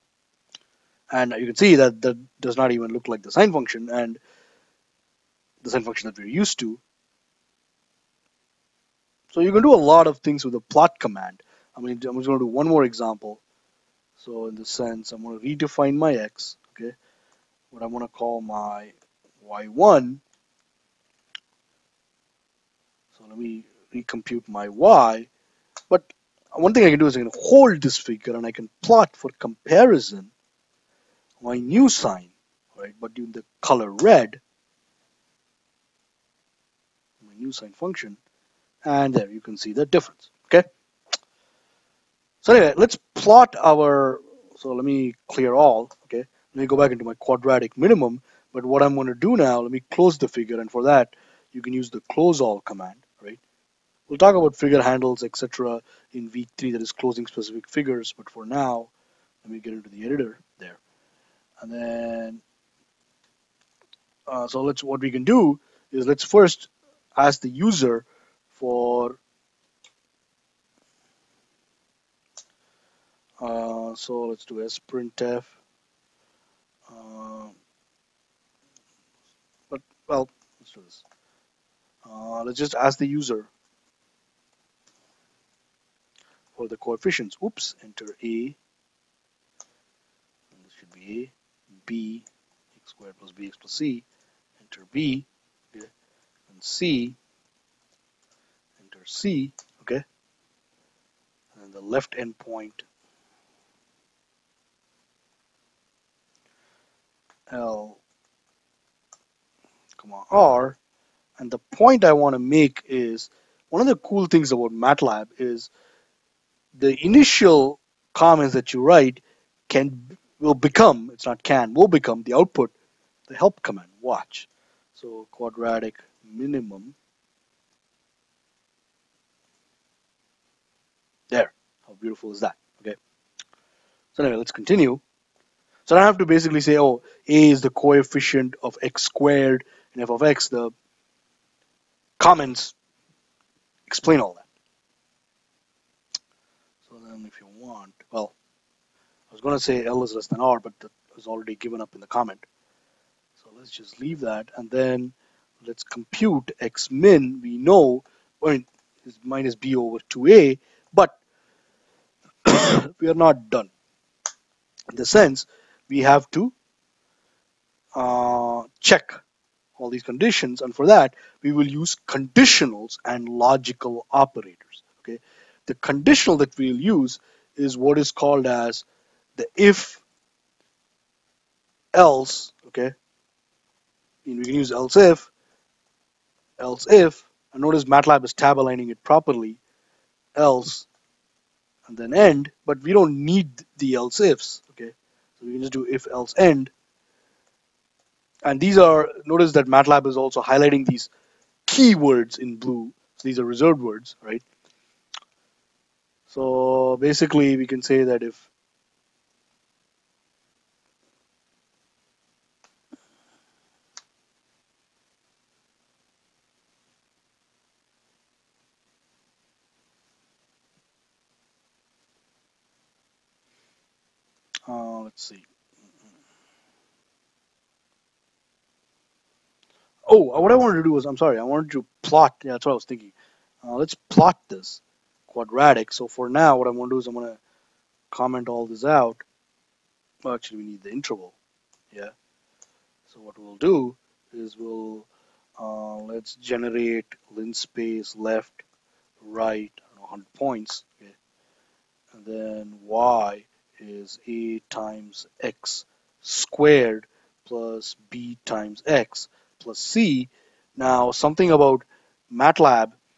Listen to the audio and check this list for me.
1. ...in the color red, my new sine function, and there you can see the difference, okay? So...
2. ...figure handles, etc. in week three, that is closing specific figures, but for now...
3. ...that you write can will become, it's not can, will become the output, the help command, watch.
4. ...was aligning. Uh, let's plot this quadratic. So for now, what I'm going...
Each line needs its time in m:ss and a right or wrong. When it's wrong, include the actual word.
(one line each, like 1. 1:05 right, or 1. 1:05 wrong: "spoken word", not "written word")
1. 0:33 right
2. 0:54 right
3. 1:58 right
4. 3:52 wrong: "thinking", not "aligning".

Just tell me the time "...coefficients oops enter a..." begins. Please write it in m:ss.
1:26.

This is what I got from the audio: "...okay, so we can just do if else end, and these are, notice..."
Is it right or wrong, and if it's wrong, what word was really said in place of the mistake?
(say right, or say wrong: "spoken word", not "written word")
right.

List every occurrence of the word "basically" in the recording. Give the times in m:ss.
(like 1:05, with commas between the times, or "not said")
2:16, 3:26.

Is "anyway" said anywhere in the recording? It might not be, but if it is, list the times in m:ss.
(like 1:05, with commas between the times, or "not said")
0:42, 2:14.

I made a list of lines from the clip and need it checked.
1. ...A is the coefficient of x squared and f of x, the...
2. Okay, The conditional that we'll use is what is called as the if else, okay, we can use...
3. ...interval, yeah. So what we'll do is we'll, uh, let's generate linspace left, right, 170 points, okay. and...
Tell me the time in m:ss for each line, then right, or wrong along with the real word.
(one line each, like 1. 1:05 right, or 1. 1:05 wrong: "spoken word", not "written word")
1. 2:17 right
2. 2:55 right
3. 4:00 wrong: "100", not "170".